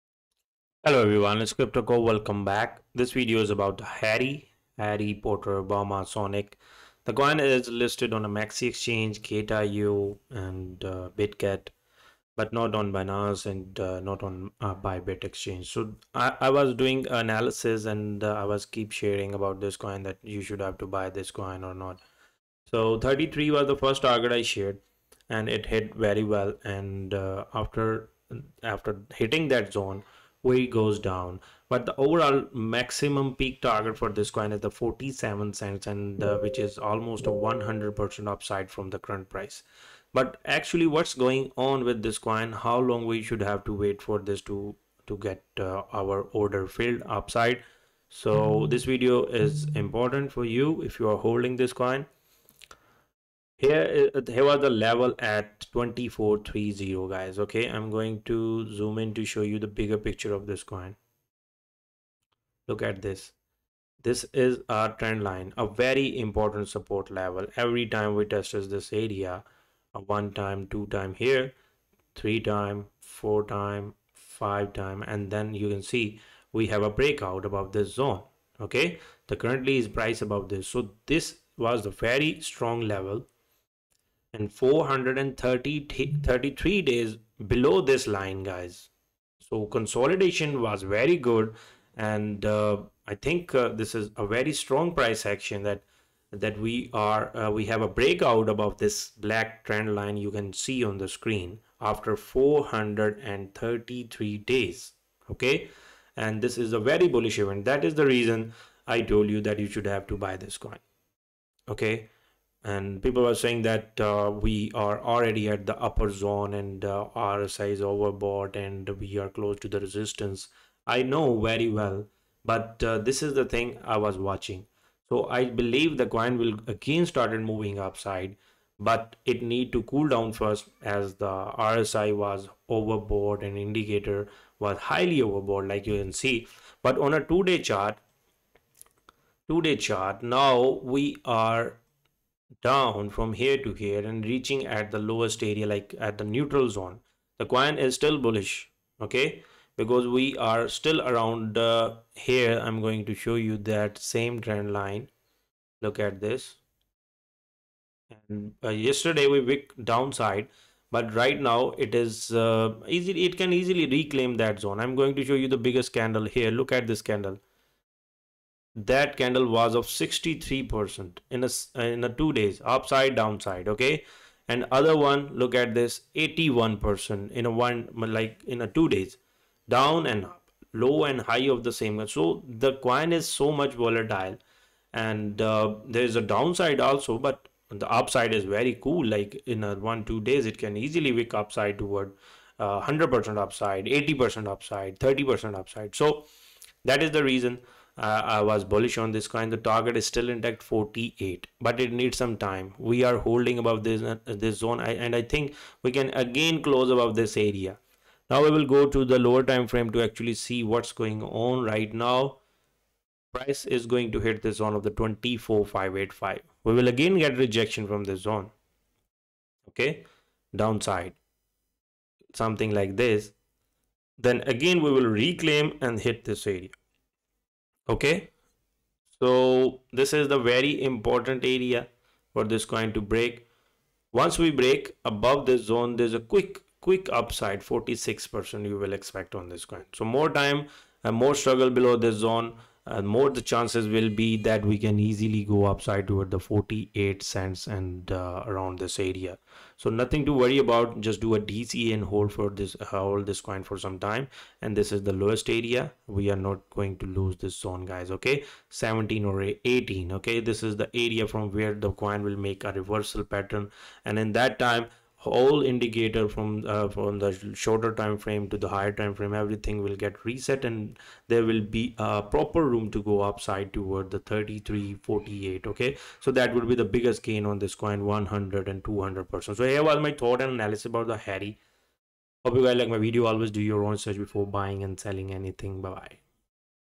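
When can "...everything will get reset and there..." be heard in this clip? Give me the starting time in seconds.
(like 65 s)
269 s.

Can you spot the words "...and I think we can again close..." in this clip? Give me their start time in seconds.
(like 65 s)
205 s.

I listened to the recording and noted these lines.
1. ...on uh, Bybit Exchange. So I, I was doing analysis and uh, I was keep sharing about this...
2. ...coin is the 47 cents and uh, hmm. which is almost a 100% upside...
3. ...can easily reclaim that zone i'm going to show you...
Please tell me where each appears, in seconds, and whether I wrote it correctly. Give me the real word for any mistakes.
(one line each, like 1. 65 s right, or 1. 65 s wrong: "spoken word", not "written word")
1. 14 s right
2. 34 s right
3. 163 s right.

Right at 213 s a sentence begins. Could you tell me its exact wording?
Price is going to hit this zone of the 24585.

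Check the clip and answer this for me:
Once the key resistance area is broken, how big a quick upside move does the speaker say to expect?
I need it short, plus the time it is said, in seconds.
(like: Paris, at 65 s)
46 percent, at 237 s.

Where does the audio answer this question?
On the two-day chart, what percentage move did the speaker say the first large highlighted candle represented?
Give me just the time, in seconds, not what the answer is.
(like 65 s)
169 s.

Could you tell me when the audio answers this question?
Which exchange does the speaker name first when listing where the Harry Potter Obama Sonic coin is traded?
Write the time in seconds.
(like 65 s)
8 s.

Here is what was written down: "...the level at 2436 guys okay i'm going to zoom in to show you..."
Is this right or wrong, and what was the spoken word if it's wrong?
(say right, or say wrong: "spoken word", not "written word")
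wrong: "2430", not "2436".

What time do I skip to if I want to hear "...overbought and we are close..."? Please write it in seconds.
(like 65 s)
117 s.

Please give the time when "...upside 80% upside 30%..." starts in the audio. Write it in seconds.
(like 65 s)
193 s.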